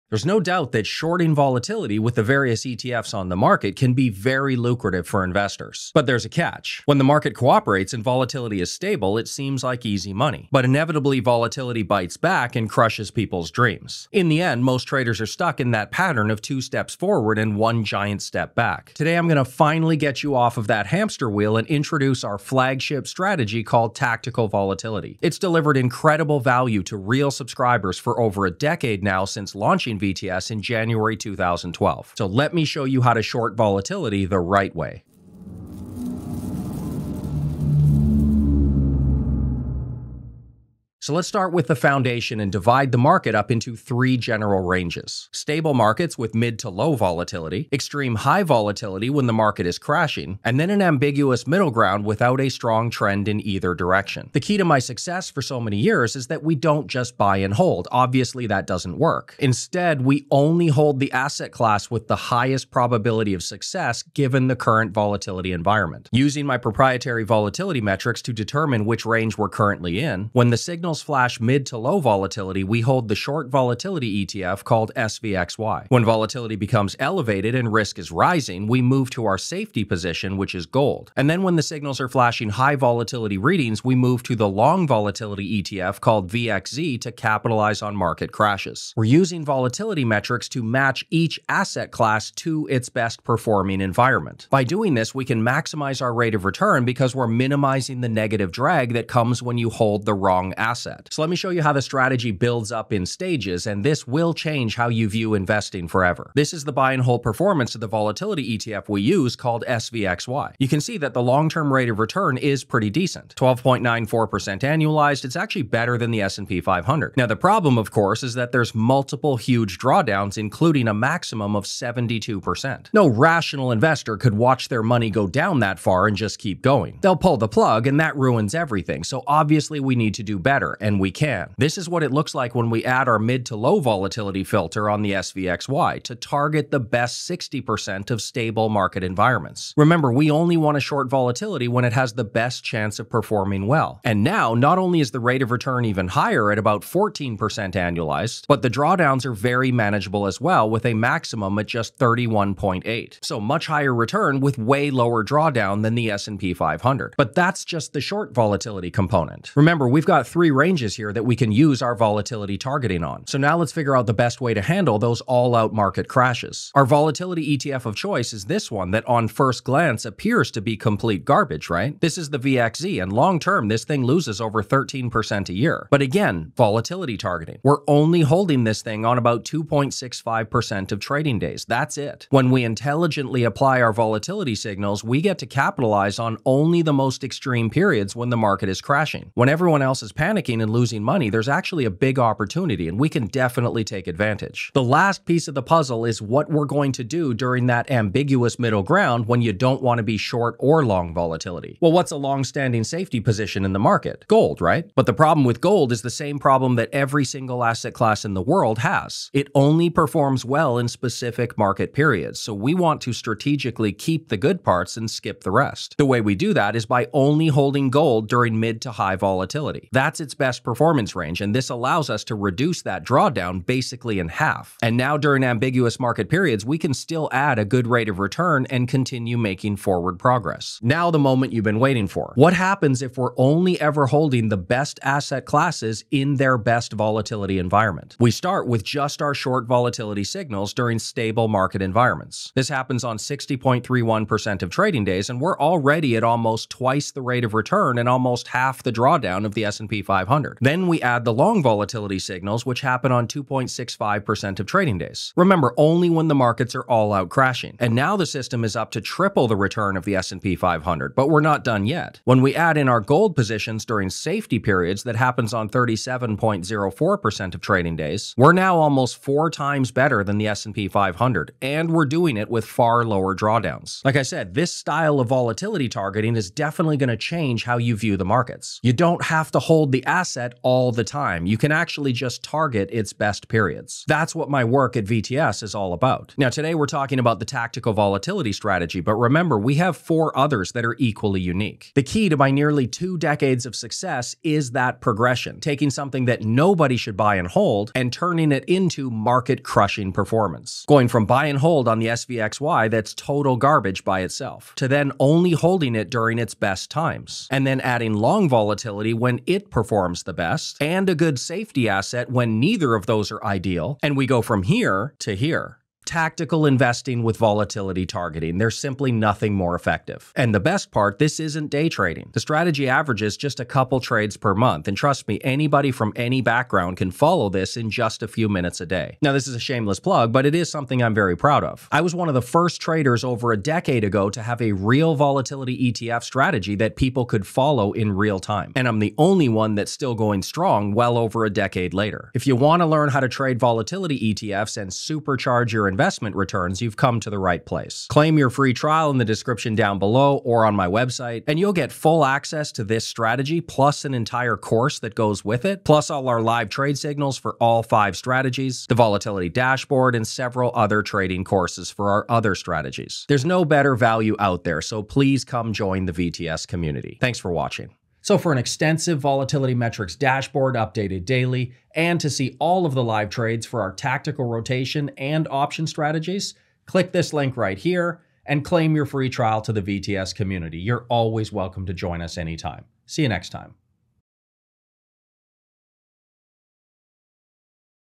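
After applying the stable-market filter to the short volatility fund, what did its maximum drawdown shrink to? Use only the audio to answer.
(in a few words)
31.8.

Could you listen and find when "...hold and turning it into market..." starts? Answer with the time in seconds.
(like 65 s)
297 s.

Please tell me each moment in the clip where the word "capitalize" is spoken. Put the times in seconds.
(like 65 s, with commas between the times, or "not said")
87 s, 185 s.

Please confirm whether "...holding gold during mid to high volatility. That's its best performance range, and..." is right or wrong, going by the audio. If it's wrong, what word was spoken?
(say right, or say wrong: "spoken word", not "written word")
right.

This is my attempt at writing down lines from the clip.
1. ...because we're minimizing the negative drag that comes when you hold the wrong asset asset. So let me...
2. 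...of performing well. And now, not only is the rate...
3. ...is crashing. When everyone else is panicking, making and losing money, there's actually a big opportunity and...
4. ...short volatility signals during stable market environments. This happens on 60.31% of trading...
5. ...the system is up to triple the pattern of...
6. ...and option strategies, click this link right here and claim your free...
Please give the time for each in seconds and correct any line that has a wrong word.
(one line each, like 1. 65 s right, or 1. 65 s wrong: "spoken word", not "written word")
1. 96 s right
2. 142 s right
3. 188 s right
4. 239 s right
5. 258 s wrong: "return", not "pattern"
6. 375 s right.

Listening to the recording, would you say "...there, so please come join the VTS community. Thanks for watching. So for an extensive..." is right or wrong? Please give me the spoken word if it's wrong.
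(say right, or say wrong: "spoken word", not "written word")
right.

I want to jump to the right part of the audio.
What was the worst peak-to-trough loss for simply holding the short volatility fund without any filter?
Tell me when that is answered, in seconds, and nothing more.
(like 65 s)
121 s.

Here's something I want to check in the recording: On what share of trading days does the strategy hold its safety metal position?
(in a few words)
37.04%.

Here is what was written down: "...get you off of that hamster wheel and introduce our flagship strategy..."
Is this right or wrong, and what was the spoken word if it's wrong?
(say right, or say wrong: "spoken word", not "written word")
right.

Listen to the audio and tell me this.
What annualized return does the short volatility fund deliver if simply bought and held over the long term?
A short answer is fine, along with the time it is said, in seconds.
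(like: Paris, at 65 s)
12.94%, at 113 s.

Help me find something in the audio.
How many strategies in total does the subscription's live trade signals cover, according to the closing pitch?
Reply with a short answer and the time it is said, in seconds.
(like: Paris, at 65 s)
5, at 357 s.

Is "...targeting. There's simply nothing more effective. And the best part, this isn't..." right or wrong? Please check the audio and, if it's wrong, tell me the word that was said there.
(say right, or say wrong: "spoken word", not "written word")
right.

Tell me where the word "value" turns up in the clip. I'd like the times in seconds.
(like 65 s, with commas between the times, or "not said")
26 s, 363 s.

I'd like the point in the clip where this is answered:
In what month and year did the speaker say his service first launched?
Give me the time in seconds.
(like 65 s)
30 s.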